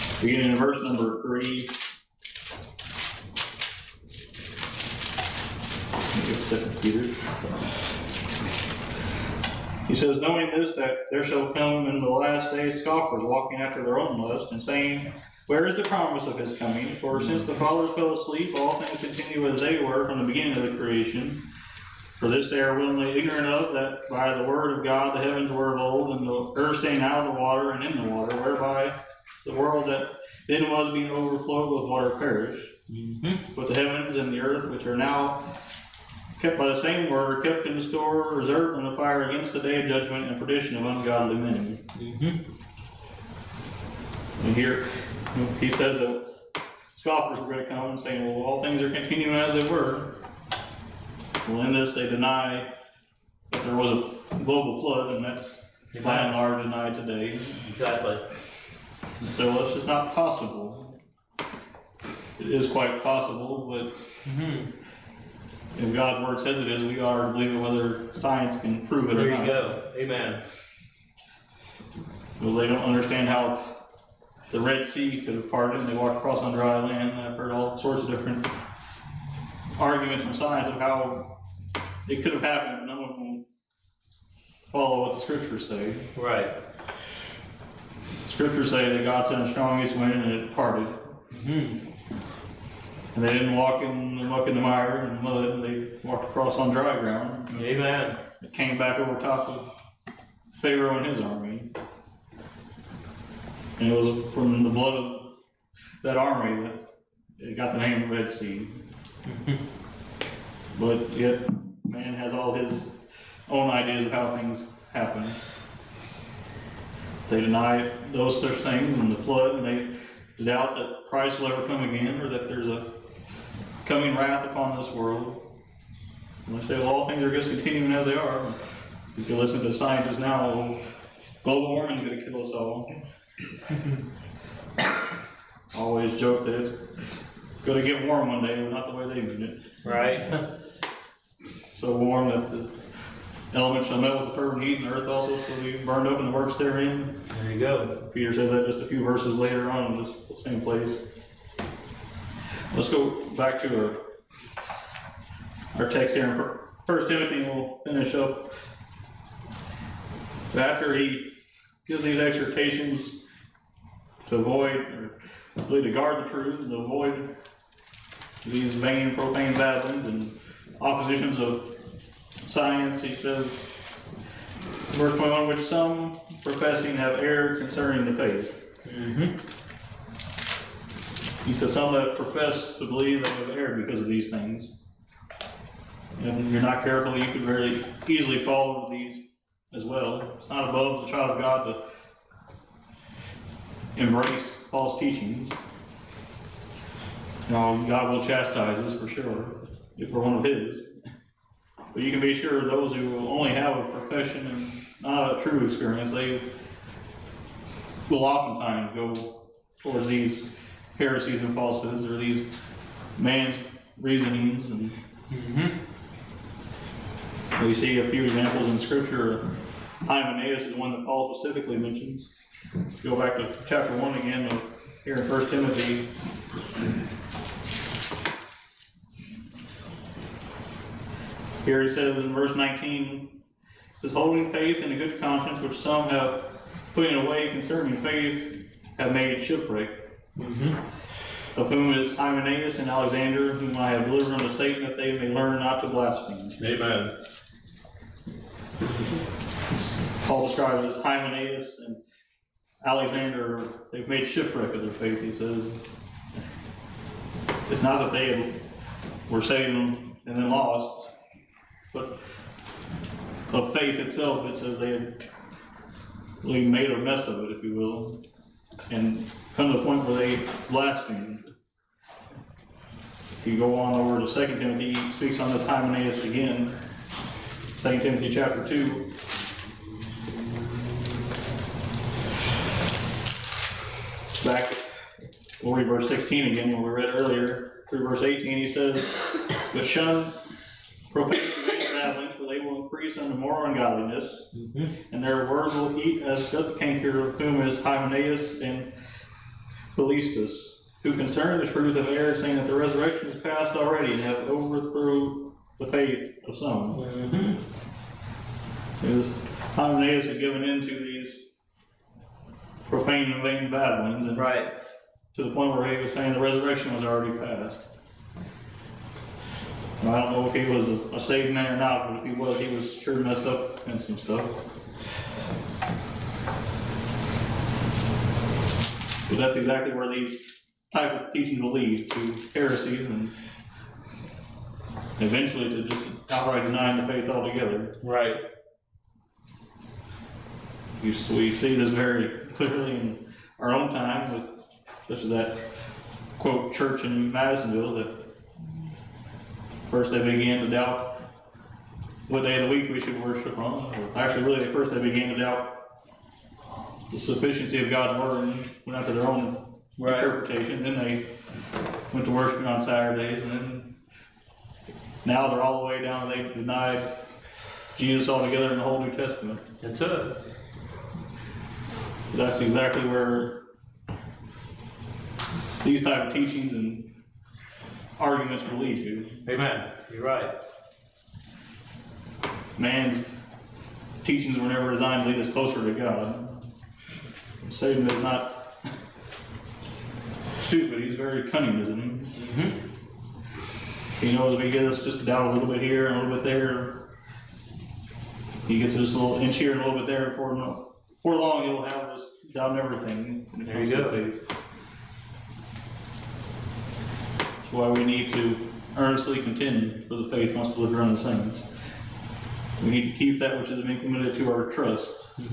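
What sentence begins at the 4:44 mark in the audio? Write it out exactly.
Back, we'll read verse 16 again, what we read earlier.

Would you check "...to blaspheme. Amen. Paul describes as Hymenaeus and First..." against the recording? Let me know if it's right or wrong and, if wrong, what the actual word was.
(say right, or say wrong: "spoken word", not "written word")
wrong: "Alexander", not "First".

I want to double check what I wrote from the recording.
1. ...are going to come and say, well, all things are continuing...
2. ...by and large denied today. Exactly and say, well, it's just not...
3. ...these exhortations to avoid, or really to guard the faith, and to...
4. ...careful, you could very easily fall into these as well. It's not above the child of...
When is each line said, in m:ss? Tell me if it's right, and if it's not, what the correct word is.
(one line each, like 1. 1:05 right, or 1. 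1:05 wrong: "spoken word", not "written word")
1. 0:47 right
2. 0:56 right
3. 2:42 wrong: "truth", not "faith"
4. 3:06 right.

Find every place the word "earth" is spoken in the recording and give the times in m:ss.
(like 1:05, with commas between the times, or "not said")
0:26, 0:34, 2:24.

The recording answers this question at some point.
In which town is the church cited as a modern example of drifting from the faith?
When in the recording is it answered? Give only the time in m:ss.
5:47.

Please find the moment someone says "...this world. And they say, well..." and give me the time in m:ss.
2:04.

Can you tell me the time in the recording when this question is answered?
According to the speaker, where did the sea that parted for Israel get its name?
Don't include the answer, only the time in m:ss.
1:44.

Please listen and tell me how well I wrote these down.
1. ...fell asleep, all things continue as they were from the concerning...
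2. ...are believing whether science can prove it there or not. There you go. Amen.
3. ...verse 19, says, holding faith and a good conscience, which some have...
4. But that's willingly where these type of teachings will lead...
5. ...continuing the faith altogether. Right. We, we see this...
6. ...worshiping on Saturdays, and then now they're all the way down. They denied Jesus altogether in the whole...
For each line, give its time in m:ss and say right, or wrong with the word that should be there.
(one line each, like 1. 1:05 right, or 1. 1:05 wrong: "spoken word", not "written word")
1. 0:17 wrong: "beginning", not "concerning"
2. 1:06 right
3. 3:52 right
4. 5:29 wrong: "exactly", not "willingly"
5. 5:36 wrong: "denying", not "continuing"
6. 6:02 right.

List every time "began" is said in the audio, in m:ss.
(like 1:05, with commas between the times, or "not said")
5:50, 5:54.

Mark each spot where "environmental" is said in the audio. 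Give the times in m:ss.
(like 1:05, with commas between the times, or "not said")
not said.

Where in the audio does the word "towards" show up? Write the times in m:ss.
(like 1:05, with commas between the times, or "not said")
3:29.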